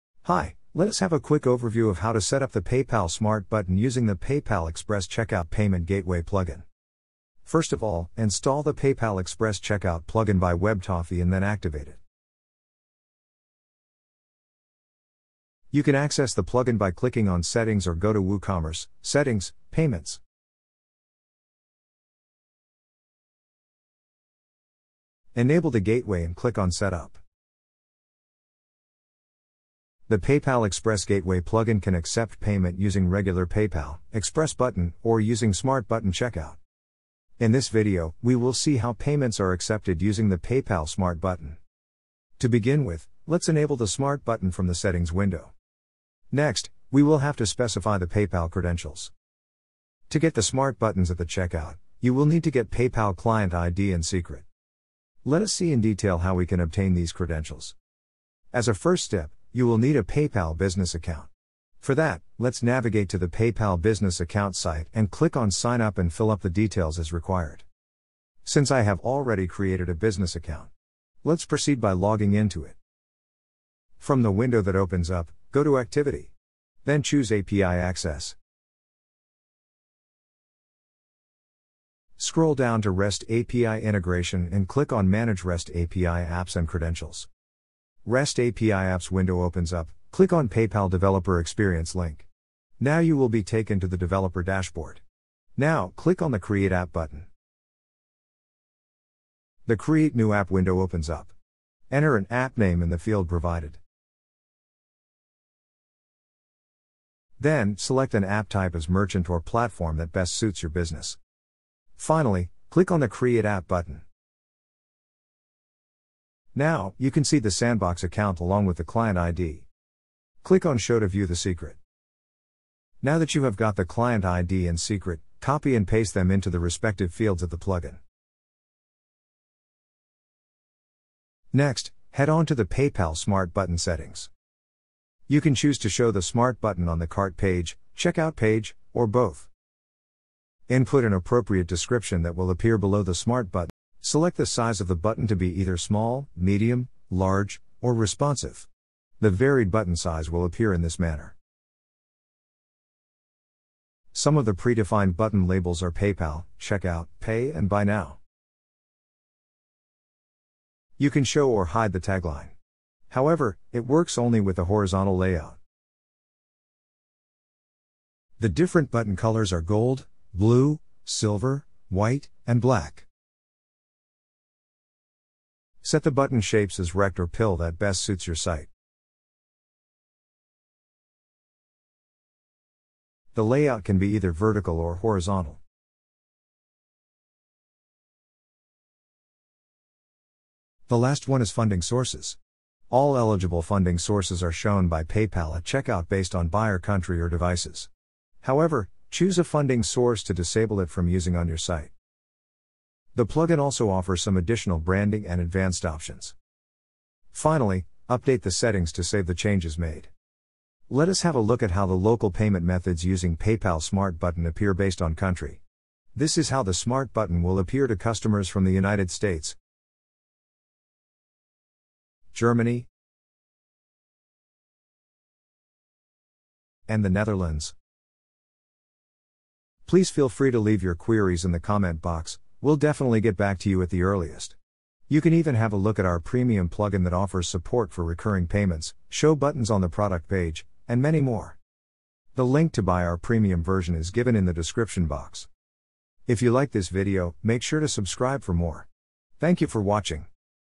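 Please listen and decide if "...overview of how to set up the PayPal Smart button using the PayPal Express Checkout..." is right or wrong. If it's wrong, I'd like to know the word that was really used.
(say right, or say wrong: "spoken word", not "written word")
right.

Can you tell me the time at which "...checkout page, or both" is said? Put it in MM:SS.
02:17.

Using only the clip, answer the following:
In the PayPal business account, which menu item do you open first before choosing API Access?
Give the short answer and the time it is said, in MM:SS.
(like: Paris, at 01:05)
Activity, at 01:15.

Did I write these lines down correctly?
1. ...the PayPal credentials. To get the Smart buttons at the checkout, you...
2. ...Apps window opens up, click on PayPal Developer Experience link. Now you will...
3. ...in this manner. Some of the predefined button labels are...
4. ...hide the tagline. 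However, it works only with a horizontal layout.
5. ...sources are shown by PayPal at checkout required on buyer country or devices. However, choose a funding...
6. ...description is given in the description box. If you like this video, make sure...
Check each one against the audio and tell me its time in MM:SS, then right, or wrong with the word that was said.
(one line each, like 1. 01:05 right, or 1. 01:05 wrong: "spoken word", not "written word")
1. 00:47 right
2. 01:28 right
3. 02:30 right
4. 02:41 right
5. 03:13 wrong: "based", not "required"
6. 04:03 wrong: "version", not "description".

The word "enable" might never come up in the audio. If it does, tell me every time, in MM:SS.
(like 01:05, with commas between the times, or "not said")
00:25, 00:43.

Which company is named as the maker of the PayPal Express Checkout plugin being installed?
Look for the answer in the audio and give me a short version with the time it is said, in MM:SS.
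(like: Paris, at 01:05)
WebToffee, at 00:10.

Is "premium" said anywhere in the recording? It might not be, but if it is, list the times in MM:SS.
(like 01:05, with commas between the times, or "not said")
03:56, 04:03.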